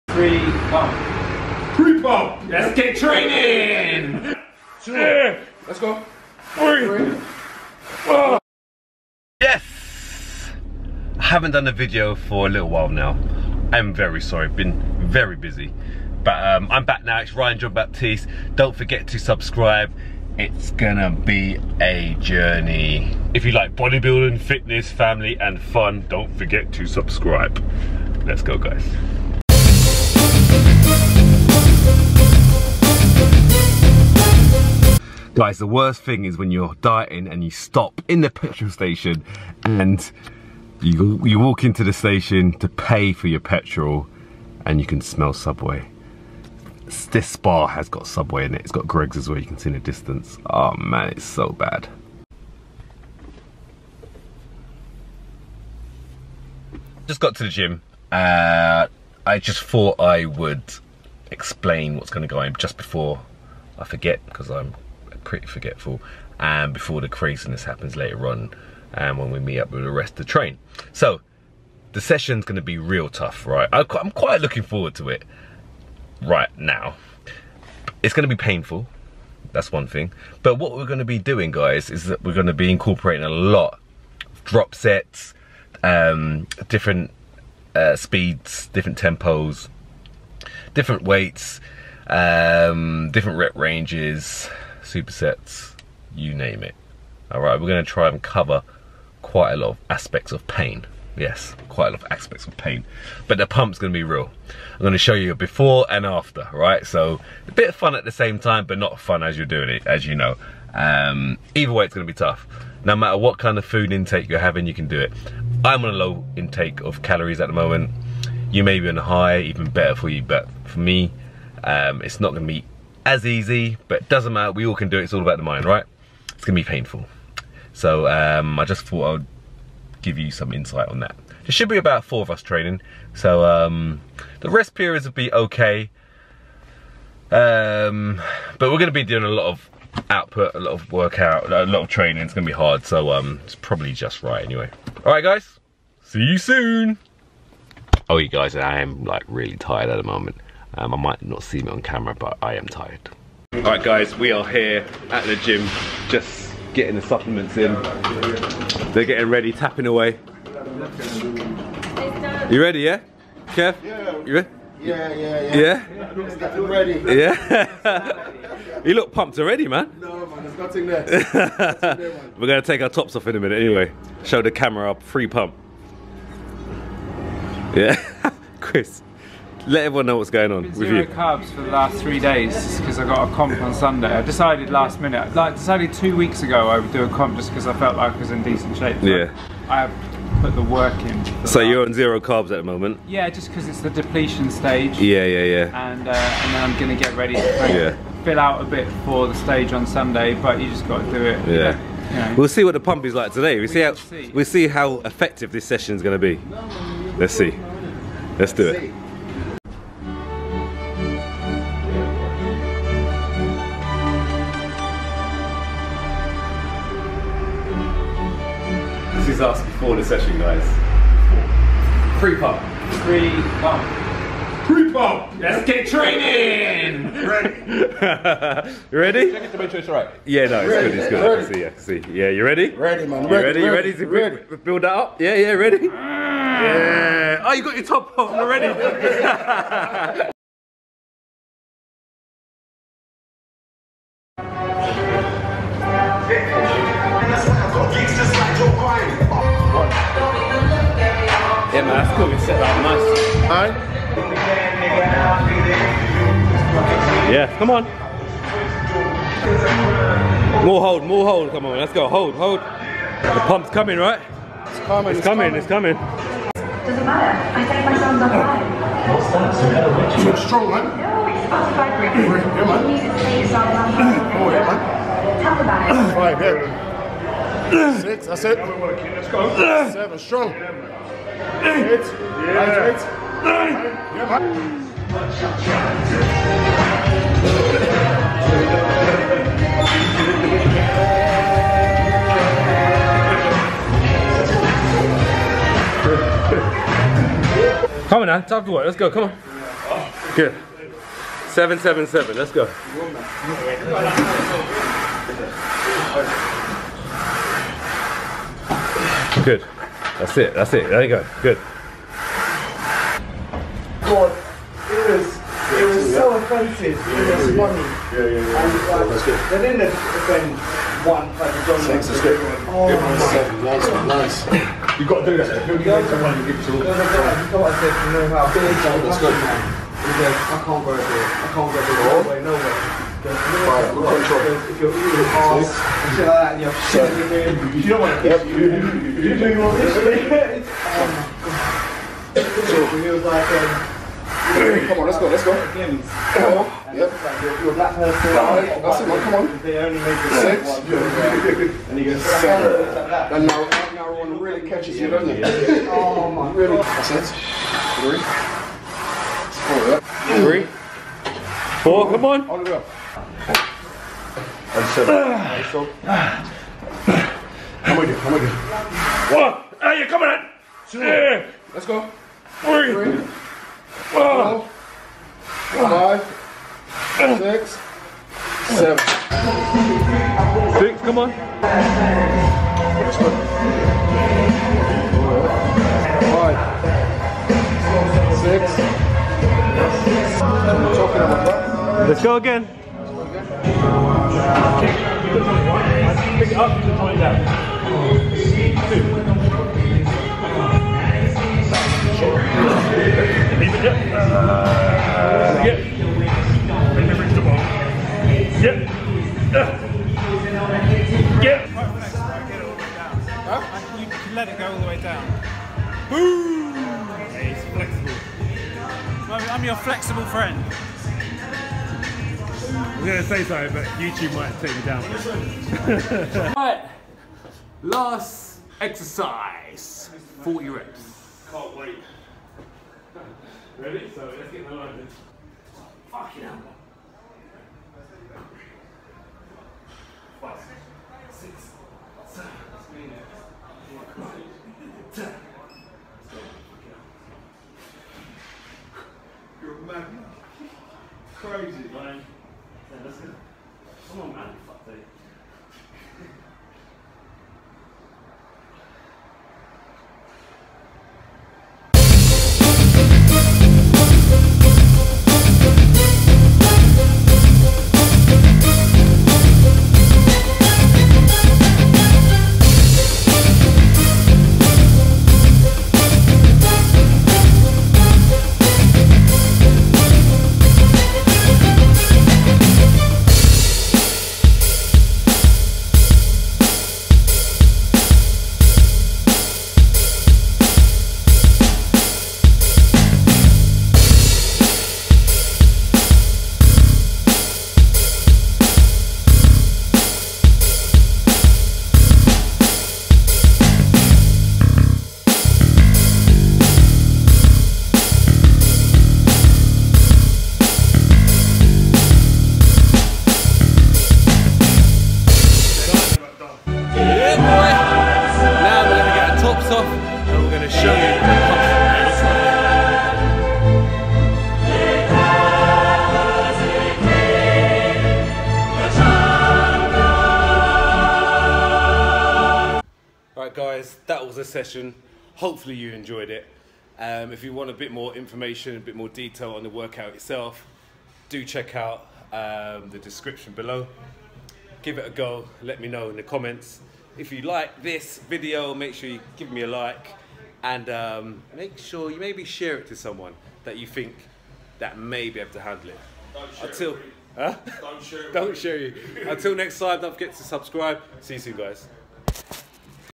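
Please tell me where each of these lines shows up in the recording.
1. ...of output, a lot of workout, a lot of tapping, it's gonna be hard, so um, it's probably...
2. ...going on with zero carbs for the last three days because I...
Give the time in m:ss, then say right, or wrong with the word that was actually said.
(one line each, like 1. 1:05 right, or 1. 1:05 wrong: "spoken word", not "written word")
1. 2:19 wrong: "training", not "tapping"
2. 3:00 right.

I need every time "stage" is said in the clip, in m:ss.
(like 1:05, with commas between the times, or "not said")
3:14, 3:19.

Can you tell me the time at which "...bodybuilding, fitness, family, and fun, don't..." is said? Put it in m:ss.
0:23.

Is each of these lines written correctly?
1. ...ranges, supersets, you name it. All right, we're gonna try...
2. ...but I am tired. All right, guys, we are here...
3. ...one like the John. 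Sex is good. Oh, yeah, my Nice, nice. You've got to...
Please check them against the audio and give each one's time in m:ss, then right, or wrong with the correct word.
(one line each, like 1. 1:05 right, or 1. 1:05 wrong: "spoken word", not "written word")
1. 1:33 right
2. 2:32 right
3. 5:21 right.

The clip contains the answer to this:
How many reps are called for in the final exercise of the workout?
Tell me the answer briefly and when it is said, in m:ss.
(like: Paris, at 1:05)
40, at 7:10.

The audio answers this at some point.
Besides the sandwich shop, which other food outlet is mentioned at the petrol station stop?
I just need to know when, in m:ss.
0:48.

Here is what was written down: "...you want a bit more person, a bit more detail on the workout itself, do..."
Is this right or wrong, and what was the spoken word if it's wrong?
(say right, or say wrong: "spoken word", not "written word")
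wrong: "information", not "person".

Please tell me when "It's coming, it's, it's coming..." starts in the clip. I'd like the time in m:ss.
4:24.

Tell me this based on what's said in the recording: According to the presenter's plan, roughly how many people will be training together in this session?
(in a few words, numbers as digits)
4.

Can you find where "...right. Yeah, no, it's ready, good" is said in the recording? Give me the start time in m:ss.
3:49.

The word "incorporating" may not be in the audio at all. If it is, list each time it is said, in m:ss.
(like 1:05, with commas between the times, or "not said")
1:22.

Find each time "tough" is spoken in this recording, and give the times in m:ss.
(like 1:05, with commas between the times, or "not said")
1:13, 1:52.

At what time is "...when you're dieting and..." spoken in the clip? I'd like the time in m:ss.
0:36.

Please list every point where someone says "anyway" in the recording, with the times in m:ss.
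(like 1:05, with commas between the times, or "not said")
2:24, 2:53.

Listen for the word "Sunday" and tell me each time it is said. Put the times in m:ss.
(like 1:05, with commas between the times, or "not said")
3:03, 3:19.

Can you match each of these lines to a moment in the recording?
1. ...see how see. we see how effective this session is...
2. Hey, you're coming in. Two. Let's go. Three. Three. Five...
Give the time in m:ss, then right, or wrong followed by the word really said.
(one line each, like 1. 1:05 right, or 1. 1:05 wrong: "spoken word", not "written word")
1. 3:23 right
2. 6:09 right.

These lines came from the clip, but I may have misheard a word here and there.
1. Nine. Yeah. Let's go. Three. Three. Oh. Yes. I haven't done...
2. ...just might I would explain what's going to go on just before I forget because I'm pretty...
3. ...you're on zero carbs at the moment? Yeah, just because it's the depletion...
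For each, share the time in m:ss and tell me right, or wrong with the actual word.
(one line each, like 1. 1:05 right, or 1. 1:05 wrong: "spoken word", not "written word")
1. 0:04 wrong: "Two", not "Nine"
2. 0:59 wrong: "thought", not "might"
3. 3:11 right.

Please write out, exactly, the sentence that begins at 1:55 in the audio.
I'm on a low intake of calories at the moment.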